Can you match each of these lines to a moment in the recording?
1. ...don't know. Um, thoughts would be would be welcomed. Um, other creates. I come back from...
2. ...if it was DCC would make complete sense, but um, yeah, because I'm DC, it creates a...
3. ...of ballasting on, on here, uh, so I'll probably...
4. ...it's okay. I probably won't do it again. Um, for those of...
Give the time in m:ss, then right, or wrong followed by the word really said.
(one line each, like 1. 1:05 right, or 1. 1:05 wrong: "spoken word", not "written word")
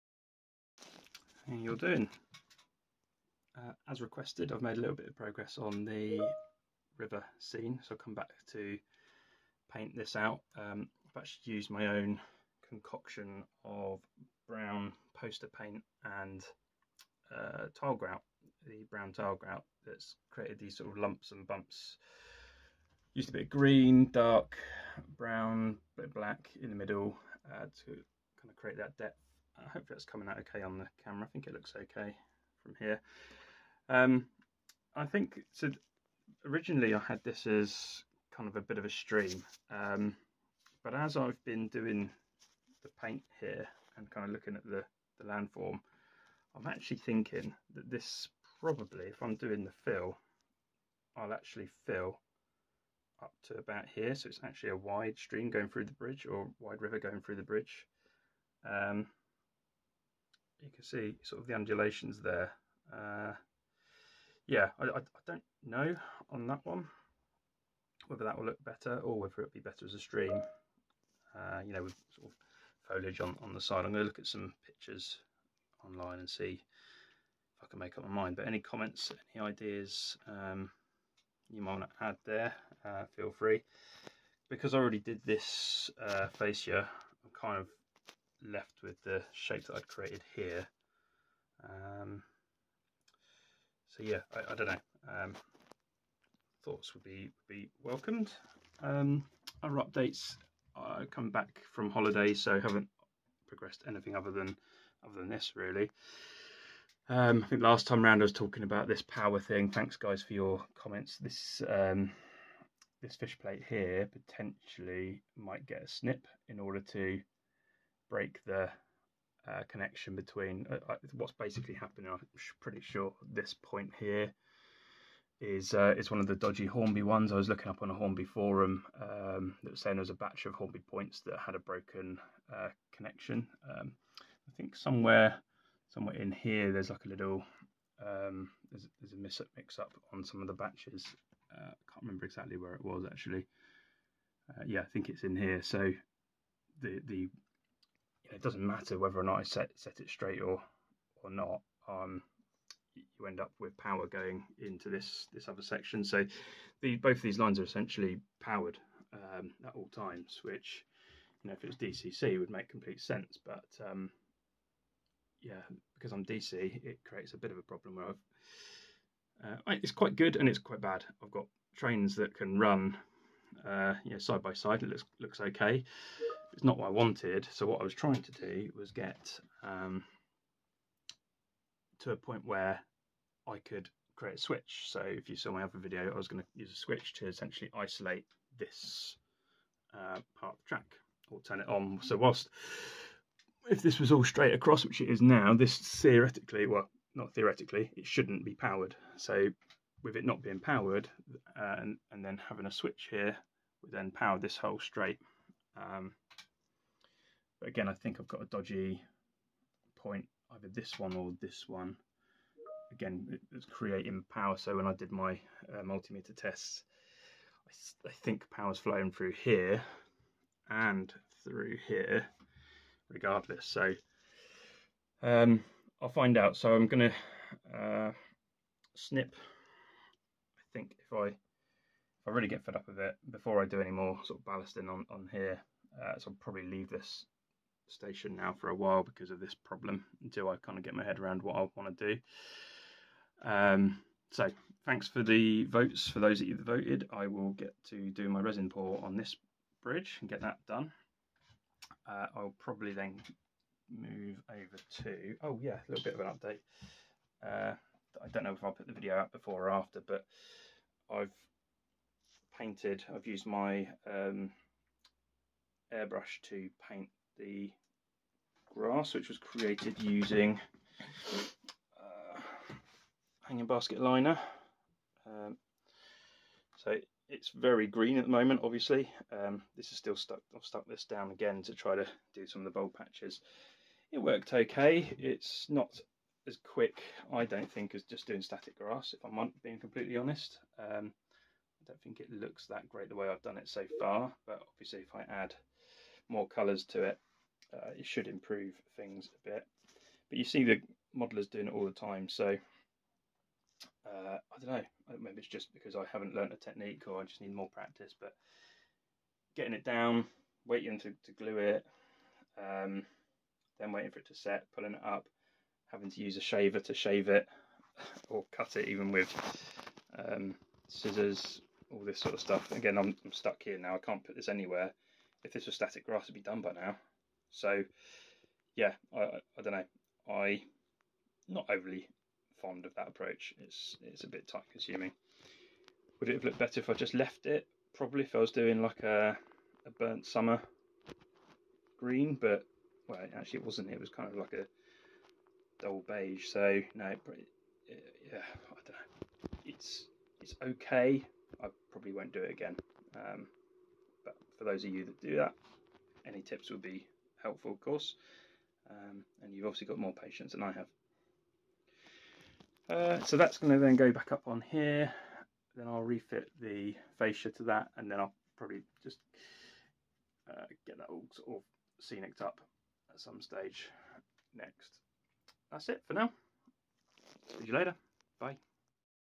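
1. 1:34 wrong: "updates", not "creates"
2. 2:41 right
3. 3:54 right
4. 5:50 right.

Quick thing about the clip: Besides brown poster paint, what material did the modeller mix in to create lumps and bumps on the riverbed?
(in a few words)
Brown tile grout.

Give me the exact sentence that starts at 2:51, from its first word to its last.
I've got trains that can run uh, you know, side by side.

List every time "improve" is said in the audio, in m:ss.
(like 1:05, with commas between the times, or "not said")
4:58.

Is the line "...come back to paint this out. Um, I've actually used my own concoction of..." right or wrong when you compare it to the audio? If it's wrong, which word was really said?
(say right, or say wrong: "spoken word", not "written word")
right.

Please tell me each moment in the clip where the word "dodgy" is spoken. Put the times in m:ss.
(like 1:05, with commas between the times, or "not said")
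2:06, 3:28.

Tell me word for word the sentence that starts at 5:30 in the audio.
I not overly fond of that approach.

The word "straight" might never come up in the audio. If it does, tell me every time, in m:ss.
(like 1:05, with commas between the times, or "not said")
2:30, 3:14, 3:24.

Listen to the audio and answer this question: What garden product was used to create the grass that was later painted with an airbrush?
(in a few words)
Hanging basket liner.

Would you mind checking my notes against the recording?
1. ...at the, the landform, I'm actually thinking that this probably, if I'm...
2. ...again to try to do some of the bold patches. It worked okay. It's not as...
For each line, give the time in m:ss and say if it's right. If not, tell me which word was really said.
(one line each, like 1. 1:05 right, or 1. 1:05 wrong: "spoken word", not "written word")
1. 0:44 right
2. 4:41 right.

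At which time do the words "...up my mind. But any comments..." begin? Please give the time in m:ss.
1:17.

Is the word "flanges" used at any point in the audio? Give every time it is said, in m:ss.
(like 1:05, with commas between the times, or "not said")
not said.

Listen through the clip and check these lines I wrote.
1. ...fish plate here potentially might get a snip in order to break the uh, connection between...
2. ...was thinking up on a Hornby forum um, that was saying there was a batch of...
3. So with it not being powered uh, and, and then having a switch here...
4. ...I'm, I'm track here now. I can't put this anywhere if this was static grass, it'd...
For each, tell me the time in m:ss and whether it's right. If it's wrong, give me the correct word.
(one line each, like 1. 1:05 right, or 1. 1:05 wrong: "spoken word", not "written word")
1. 1:53 right
2. 2:07 wrong: "looking", not "thinking"
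3. 3:19 right
4. 5:22 wrong: "stuck", not "track".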